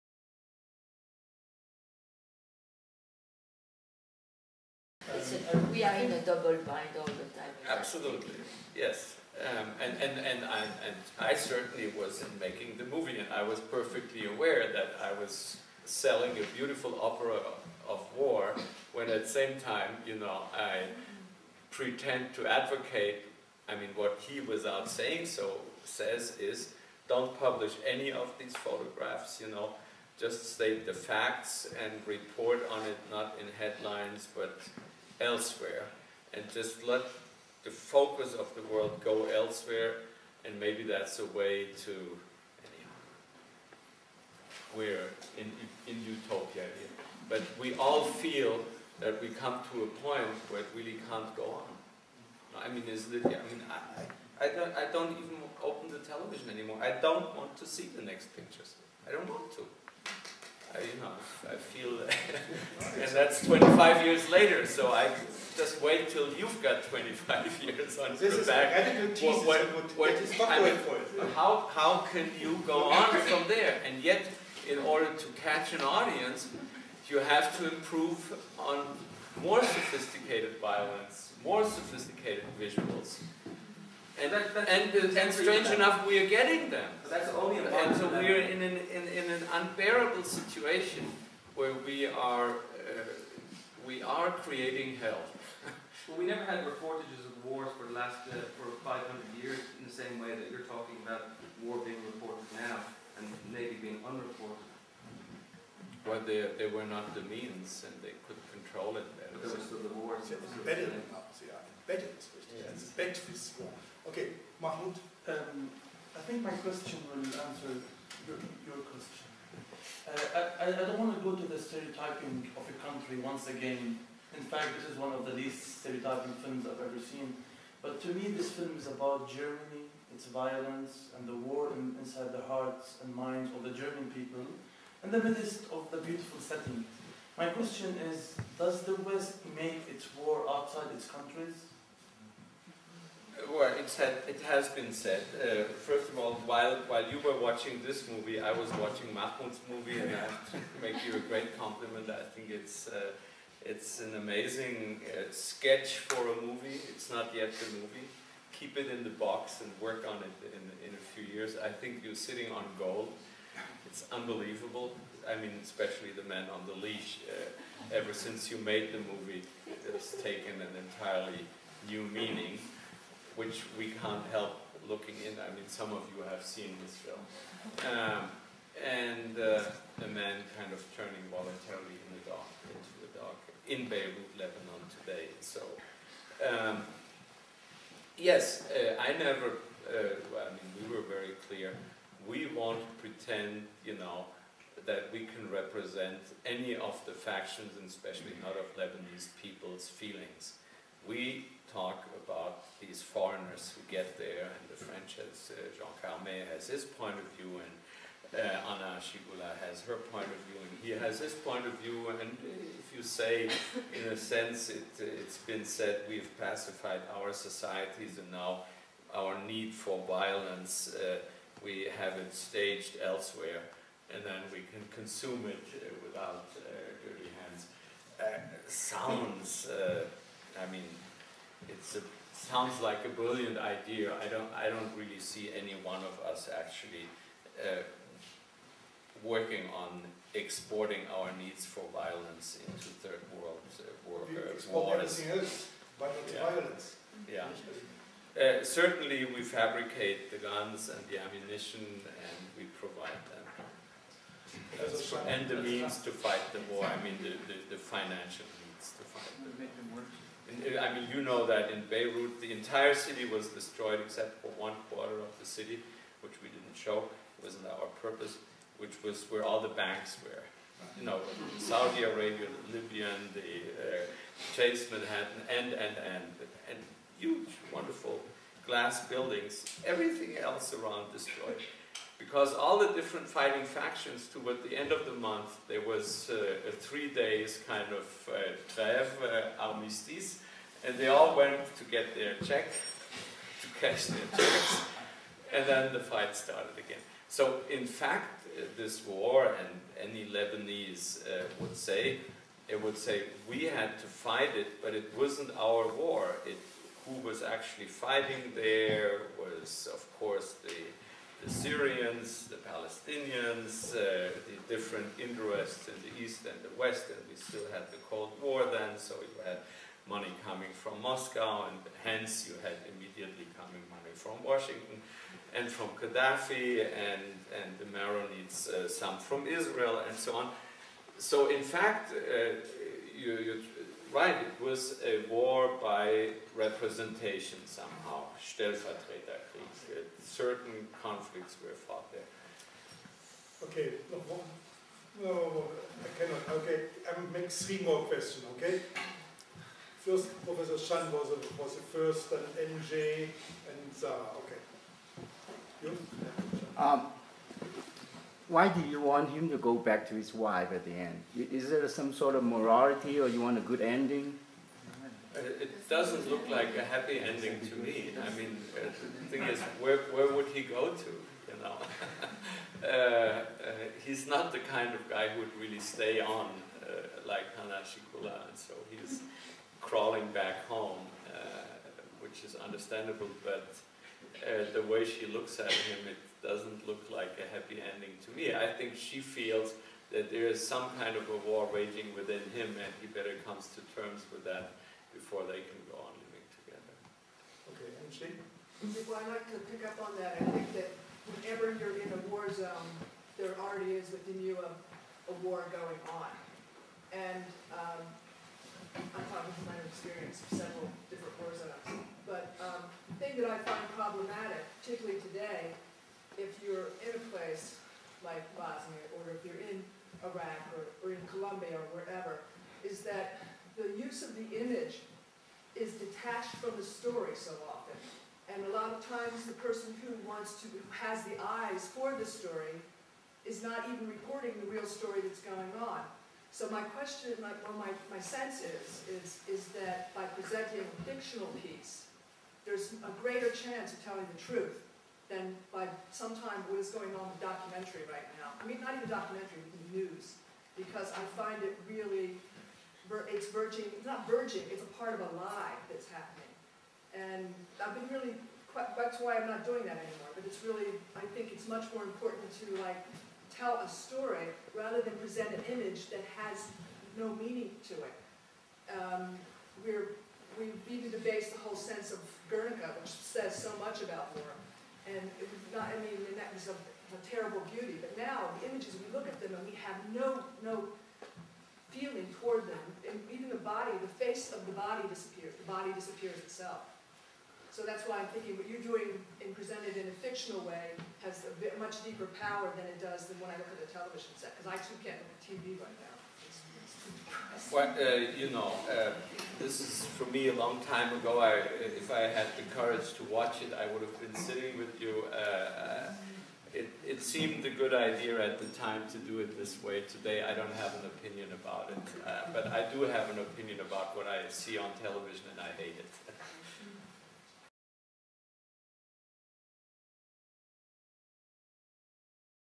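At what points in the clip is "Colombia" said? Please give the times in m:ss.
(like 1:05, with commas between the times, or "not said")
7:01.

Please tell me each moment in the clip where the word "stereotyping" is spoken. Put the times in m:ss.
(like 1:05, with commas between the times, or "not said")
2:01, 2:05.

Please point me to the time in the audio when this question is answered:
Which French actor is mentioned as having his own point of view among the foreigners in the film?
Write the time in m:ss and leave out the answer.
3:25.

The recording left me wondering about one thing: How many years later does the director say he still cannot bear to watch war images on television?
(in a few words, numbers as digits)
25.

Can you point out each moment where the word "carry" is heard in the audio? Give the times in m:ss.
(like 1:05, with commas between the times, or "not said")
not said.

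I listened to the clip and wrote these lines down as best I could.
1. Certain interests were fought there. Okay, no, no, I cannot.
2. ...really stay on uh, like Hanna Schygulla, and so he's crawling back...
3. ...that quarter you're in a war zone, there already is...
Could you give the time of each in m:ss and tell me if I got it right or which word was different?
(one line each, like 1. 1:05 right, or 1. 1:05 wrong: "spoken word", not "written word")
1. 5:40 wrong: "conflicts", not "interests"
2. 6:15 right
3. 6:40 wrong: "whenever", not "quarter".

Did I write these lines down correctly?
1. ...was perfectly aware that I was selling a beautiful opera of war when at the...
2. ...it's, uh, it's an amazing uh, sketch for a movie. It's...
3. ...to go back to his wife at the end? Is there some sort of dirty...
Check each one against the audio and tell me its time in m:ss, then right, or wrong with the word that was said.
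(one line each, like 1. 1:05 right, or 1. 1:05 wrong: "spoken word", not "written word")
1. 0:13 right
2. 2:32 right
3. 5:59 wrong: "morality", not "dirty".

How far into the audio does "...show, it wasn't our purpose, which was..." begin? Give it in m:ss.
4:26.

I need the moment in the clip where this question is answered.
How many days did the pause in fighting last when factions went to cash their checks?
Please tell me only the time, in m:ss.
4:46.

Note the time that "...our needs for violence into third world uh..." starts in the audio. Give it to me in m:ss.
4:01.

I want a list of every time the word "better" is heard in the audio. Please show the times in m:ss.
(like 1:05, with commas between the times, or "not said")
1:49, 6:33.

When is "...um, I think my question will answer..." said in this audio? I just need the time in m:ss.
1:55.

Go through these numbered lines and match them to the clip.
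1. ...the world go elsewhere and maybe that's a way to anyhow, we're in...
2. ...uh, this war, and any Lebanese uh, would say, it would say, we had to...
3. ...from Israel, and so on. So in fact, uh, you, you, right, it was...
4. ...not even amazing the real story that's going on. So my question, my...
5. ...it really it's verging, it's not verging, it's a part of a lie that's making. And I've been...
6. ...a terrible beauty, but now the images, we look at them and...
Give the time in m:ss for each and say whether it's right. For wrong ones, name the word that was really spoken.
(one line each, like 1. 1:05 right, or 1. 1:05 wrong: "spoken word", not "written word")
1. 0:38 right
2. 4:58 right
3. 5:29 right
4. 7:13 wrong: "reporting", not "amazing"
5. 7:31 wrong: "happening", not "making"
6. 7:56 right.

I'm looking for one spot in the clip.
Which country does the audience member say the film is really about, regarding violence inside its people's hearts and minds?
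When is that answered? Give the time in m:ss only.
2:09.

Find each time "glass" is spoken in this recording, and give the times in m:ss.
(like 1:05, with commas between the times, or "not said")
4:38.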